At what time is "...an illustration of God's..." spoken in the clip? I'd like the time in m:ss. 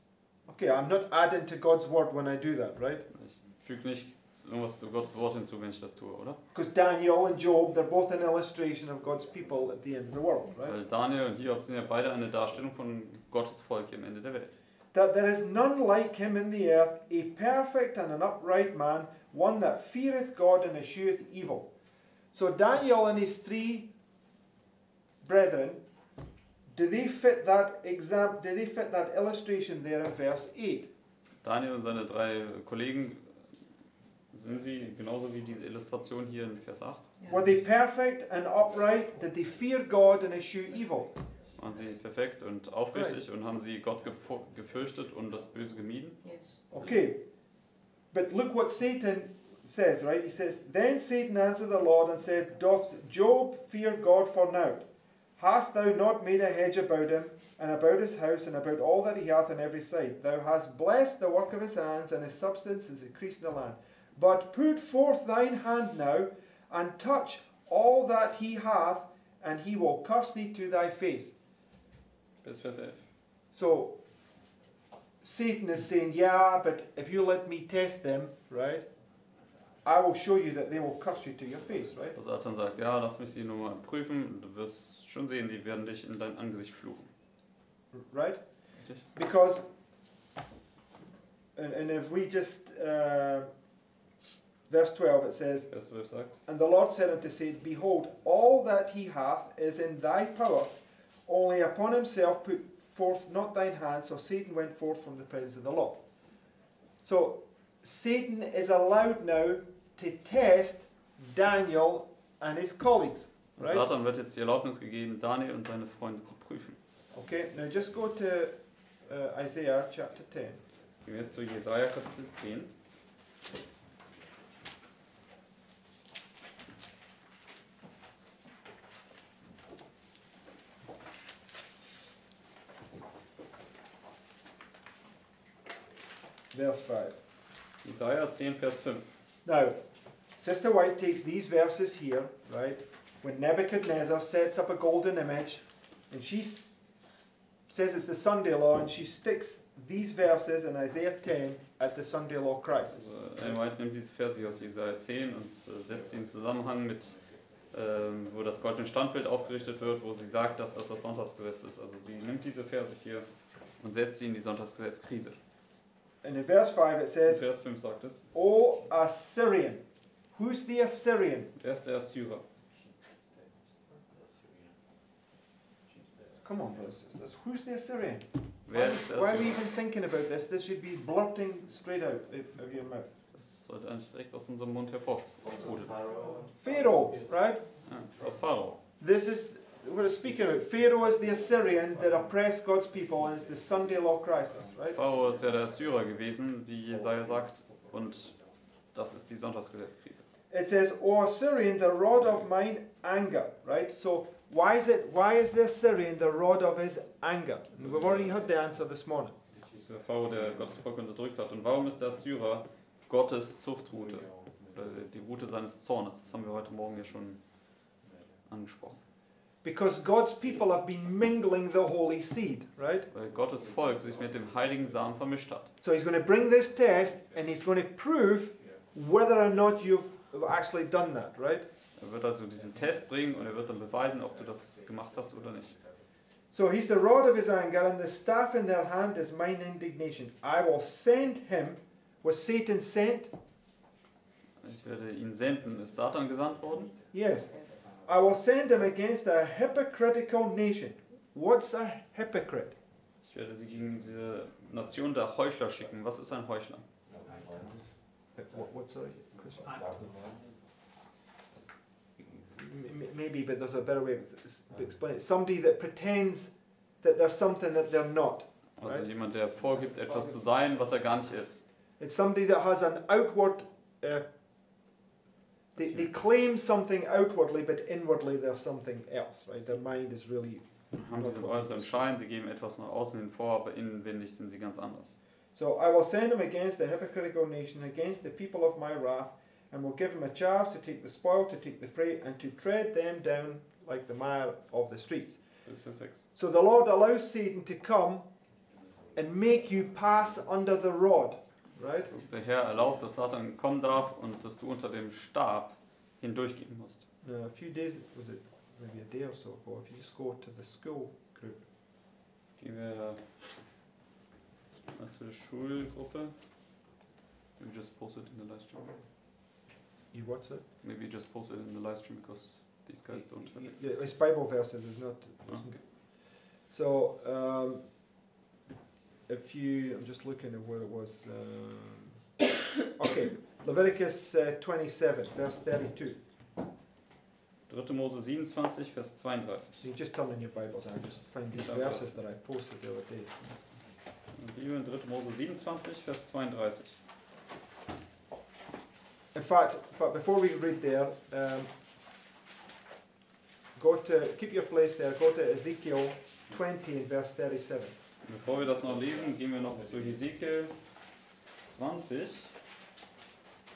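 0:08.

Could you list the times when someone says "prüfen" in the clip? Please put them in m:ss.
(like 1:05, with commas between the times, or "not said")
1:23, 1:56.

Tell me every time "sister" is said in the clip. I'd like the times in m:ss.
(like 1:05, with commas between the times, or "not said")
2:20, 2:57.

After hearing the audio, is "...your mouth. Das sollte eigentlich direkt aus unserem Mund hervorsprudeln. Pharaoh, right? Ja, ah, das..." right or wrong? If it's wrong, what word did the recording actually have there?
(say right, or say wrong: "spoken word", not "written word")
right.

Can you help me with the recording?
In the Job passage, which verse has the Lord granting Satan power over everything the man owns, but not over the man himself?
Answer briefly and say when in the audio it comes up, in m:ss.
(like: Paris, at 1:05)
Verse 12, at 1:34.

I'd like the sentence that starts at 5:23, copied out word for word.
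Yeah, it's Bible verses, it's not.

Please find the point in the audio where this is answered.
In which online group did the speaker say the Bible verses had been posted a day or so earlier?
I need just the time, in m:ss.
5:10.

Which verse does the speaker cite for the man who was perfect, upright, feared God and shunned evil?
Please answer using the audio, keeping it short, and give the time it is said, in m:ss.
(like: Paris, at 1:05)
Verse 8, at 0:30.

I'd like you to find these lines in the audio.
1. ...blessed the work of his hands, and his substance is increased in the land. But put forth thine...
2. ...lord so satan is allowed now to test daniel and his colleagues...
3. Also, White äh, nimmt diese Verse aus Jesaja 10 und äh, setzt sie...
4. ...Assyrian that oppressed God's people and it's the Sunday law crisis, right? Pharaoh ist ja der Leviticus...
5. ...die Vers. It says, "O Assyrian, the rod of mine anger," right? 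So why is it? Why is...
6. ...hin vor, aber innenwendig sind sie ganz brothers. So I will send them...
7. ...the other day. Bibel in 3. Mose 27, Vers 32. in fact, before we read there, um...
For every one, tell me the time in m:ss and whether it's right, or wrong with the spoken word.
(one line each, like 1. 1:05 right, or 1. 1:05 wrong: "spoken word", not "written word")
1. 1:00 right
2. 1:45 right
3. 2:33 right
4. 3:11 wrong: "Assyrer", not "Leviticus"
5. 3:19 wrong: "Sonntagsgesetzkrise", not "Vers"
6. 4:43 wrong: "anders", not "brothers"
7. 5:42 right.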